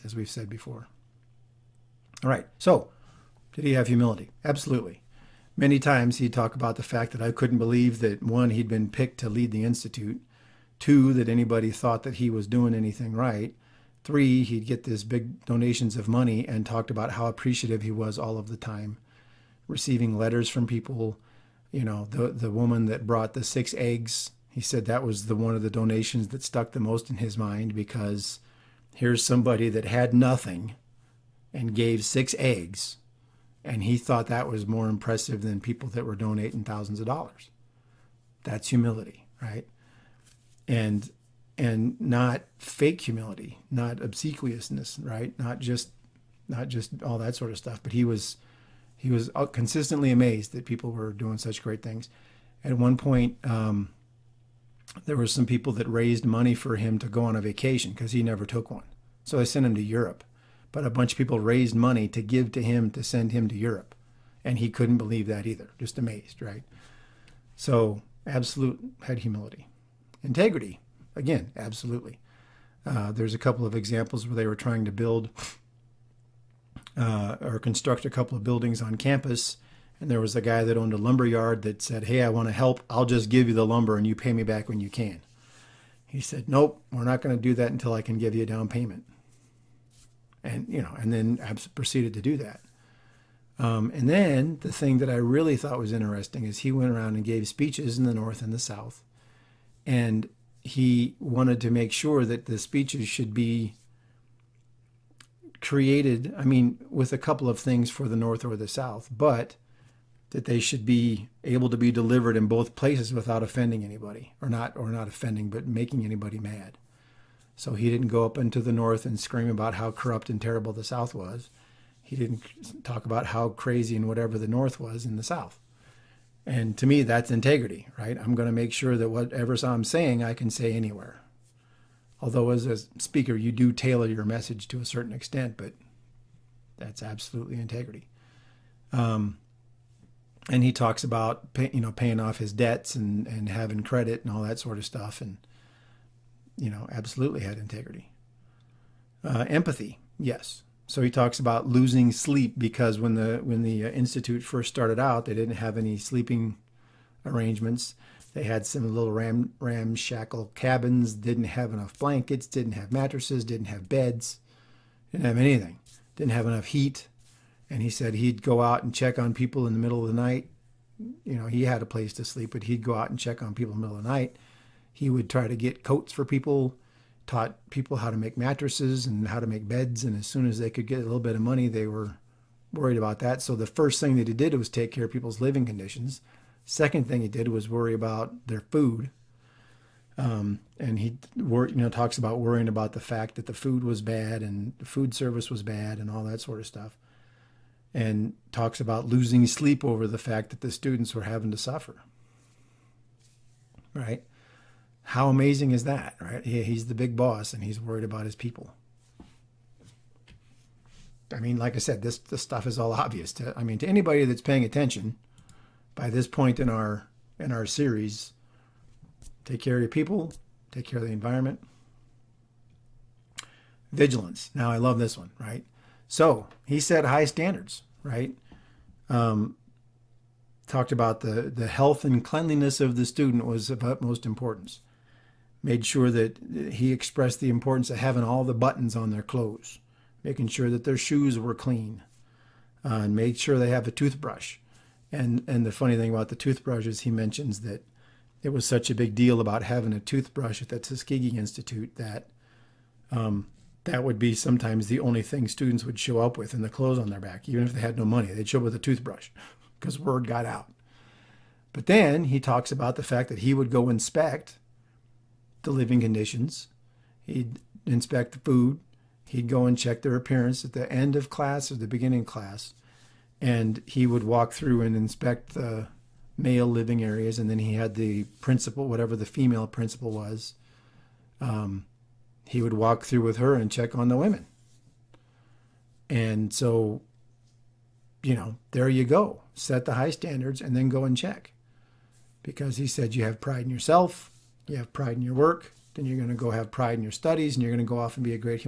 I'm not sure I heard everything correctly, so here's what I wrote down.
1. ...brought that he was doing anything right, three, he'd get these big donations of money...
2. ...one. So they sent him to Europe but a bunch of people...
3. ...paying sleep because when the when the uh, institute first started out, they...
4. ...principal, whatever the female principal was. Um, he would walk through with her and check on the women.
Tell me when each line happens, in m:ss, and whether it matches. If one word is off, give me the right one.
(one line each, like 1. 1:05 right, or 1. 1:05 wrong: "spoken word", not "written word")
1. 0:11 wrong: "thought", not "brought"
2. 0:58 right
3. 2:31 wrong: "losing", not "paying"
4. 4:38 right.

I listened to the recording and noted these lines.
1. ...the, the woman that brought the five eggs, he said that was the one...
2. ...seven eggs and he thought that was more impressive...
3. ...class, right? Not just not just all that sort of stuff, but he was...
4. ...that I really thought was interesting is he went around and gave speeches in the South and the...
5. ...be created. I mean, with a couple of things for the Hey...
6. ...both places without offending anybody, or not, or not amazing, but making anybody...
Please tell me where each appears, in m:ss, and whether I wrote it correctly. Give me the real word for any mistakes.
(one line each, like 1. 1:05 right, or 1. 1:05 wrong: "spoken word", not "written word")
1. 0:22 wrong: "six", not "five"
2. 0:32 wrong: "six", not "seven"
3. 0:44 wrong: "obsequiousness", not "class"
4. 1:34 wrong: "North", not "South"
5. 1:43 wrong: "North", not "Hey"
6. 1:52 wrong: "offending", not "amazing".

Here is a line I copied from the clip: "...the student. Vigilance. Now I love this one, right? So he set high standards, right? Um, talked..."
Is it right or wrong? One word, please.
wrong.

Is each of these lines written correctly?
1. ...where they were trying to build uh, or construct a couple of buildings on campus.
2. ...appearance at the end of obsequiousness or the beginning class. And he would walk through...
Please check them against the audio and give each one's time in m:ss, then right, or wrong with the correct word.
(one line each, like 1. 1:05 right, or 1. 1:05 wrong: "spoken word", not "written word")
1. 1:14 right
2. 4:30 wrong: "class", not "obsequiousness".